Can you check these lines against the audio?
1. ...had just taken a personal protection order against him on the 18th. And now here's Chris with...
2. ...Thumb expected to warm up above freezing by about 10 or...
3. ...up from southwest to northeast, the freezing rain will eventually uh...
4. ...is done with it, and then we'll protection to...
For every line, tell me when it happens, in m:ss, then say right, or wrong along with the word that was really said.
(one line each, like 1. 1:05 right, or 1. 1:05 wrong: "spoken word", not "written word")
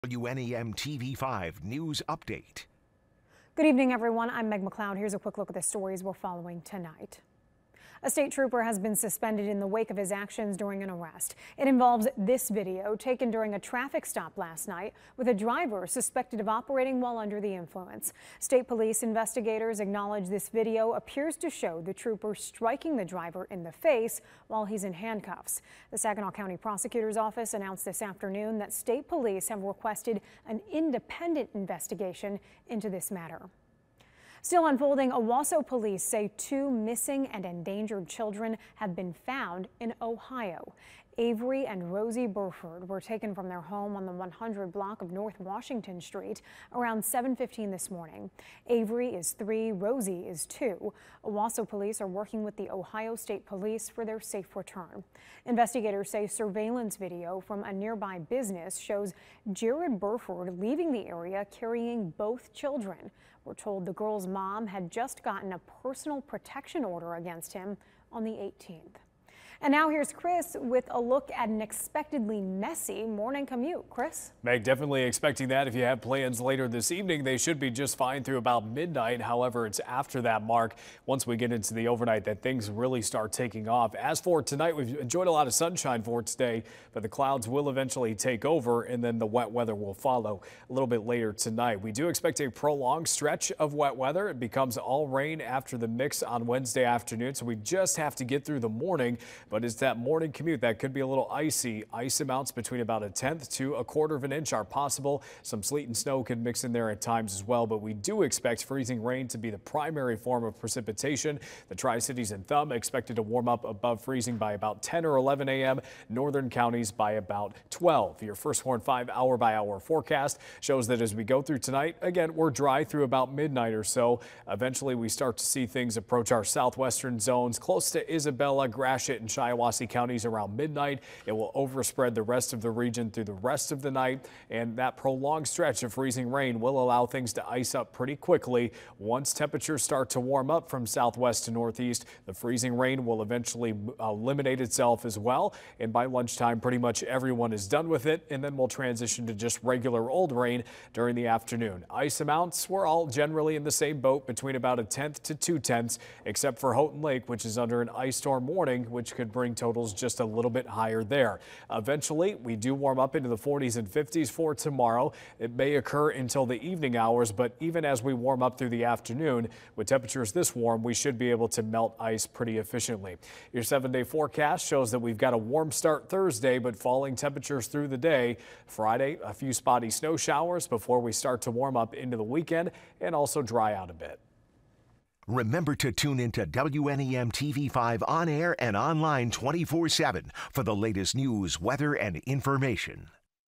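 1. 1:04 wrong: "gotten", not "taken"
2. 1:52 right
3. 2:20 right
4. 2:27 wrong: "transition", not "protection".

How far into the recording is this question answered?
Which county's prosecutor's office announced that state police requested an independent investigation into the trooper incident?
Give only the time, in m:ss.
0:25.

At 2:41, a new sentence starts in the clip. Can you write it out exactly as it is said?
Eventually, we do warm up into the 40s and 50s for tomorrow.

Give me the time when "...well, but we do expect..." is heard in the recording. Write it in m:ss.
1:47.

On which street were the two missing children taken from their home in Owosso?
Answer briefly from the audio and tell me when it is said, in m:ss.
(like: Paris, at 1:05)
North Washington Street, at 0:45.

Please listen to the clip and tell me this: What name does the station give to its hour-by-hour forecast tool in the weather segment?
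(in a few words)
First Warn 5.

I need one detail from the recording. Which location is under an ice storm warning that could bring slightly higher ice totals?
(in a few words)
Houghton Lake.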